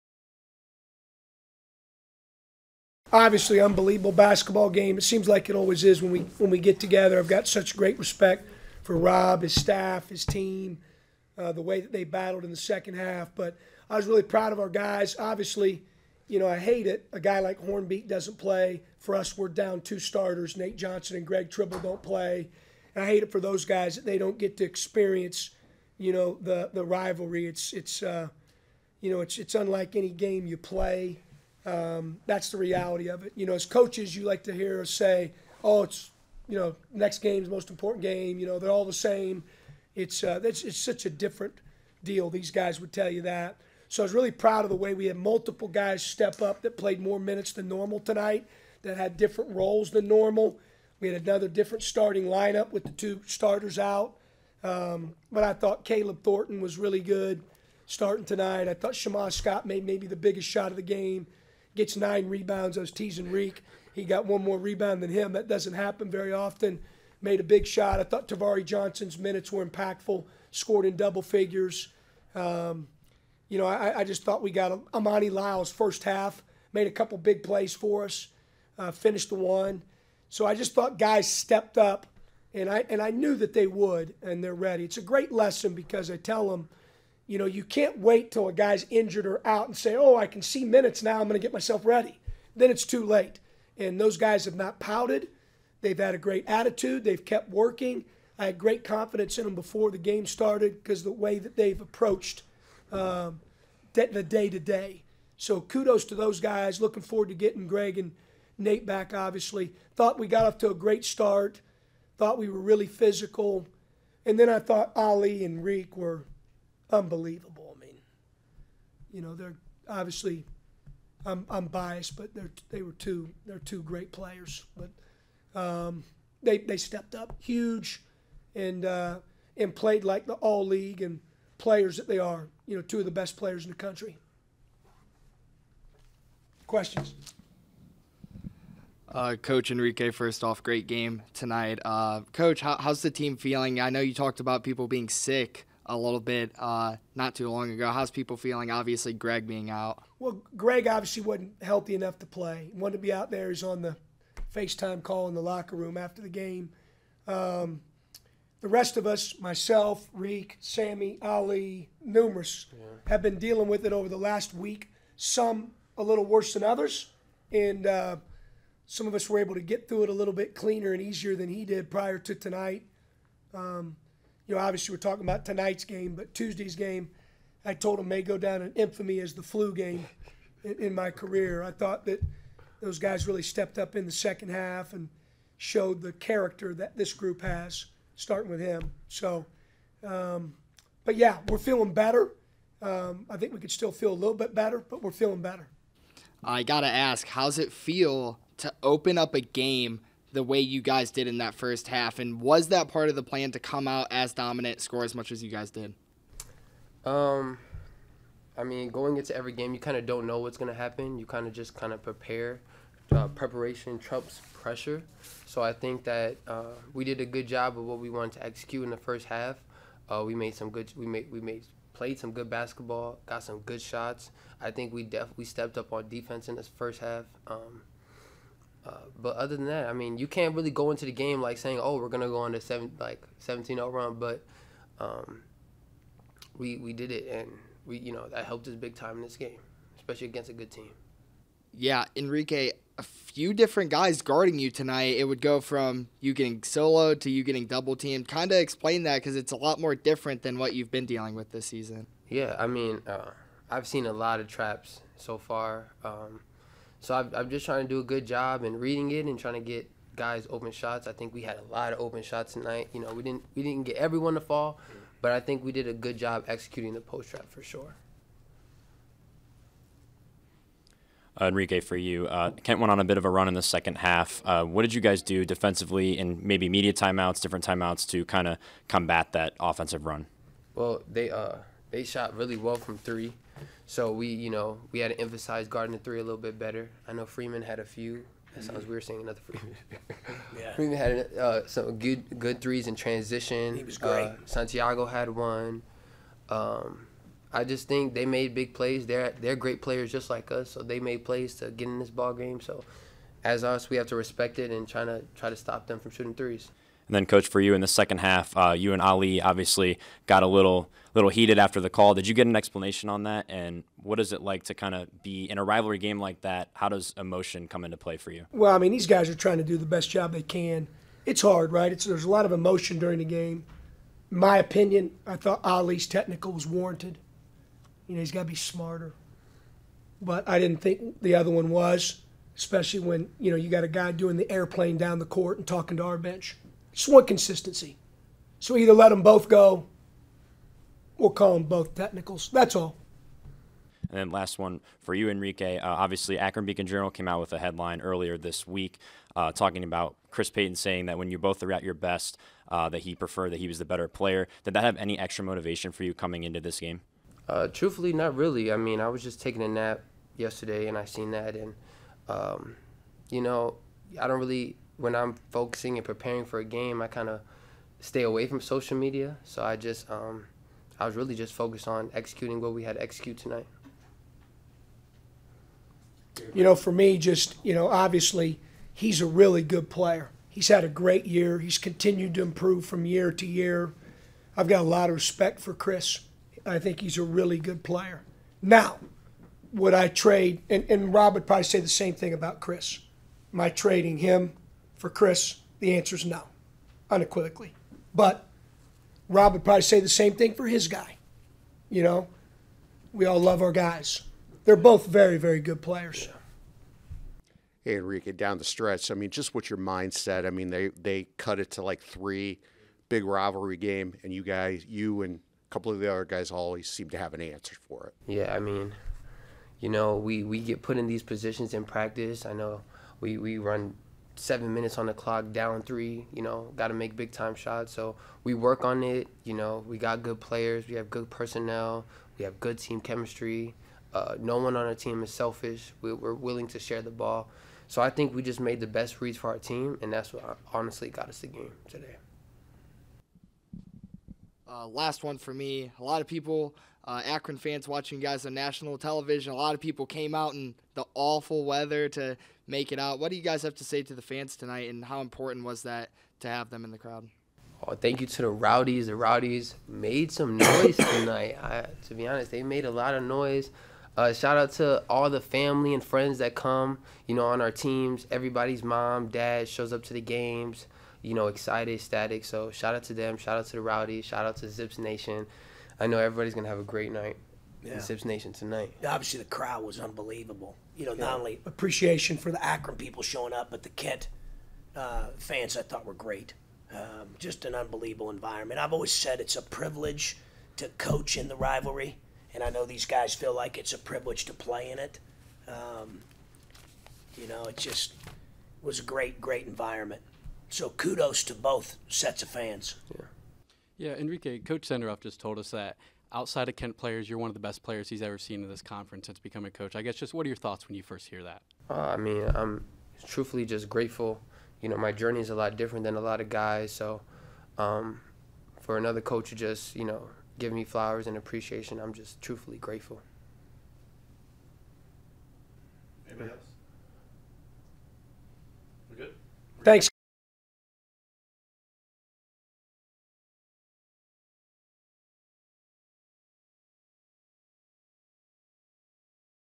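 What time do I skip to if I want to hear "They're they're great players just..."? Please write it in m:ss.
4:59.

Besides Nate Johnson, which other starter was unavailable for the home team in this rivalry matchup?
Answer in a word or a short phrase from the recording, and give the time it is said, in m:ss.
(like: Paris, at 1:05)
Greg Tribble, at 0:21.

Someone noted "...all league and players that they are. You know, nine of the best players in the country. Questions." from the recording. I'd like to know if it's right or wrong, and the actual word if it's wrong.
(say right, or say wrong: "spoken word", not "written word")
wrong: "two", not "nine".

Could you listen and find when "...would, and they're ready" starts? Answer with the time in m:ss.
1:23.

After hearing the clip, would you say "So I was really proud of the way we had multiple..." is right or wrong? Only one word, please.
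right.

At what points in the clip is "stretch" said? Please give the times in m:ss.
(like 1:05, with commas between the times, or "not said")
6:48.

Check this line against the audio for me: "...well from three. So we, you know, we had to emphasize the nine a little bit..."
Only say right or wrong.
wrong.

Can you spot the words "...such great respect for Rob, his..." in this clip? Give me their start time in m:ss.
0:07.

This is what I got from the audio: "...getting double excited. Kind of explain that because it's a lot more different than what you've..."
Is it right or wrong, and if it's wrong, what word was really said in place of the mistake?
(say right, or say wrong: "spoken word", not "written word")
wrong: "teamed", not "excited".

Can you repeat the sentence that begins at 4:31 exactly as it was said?
Uh, Enrique, for you, uh, Kent went on a bit of a run in the second half.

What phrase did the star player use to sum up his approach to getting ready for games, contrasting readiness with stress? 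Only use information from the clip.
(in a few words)
Preparation trumps pressure.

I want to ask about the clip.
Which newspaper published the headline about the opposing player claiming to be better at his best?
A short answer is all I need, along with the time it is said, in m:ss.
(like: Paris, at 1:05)
Akron Beacon Journal, at 5:46.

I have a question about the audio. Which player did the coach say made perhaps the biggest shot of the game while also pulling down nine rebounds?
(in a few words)
Shammah Scott.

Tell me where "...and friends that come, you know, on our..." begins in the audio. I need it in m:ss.
7:45.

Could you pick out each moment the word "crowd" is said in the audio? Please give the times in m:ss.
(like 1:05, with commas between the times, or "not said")
7:36, 7:59.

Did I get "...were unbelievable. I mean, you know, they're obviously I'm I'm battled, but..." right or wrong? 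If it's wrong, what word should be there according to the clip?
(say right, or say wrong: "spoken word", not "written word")
wrong: "biased", not "battled".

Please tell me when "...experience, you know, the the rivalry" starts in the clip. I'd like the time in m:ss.
0:24.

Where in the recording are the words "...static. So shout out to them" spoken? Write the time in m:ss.
7:52.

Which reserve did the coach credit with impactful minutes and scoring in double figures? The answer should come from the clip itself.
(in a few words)
Tavari Johnson.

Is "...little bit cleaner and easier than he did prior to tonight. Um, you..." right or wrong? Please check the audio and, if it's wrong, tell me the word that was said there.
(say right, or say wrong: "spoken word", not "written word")
right.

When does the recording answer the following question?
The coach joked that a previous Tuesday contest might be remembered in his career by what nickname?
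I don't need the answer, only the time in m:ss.
2:59.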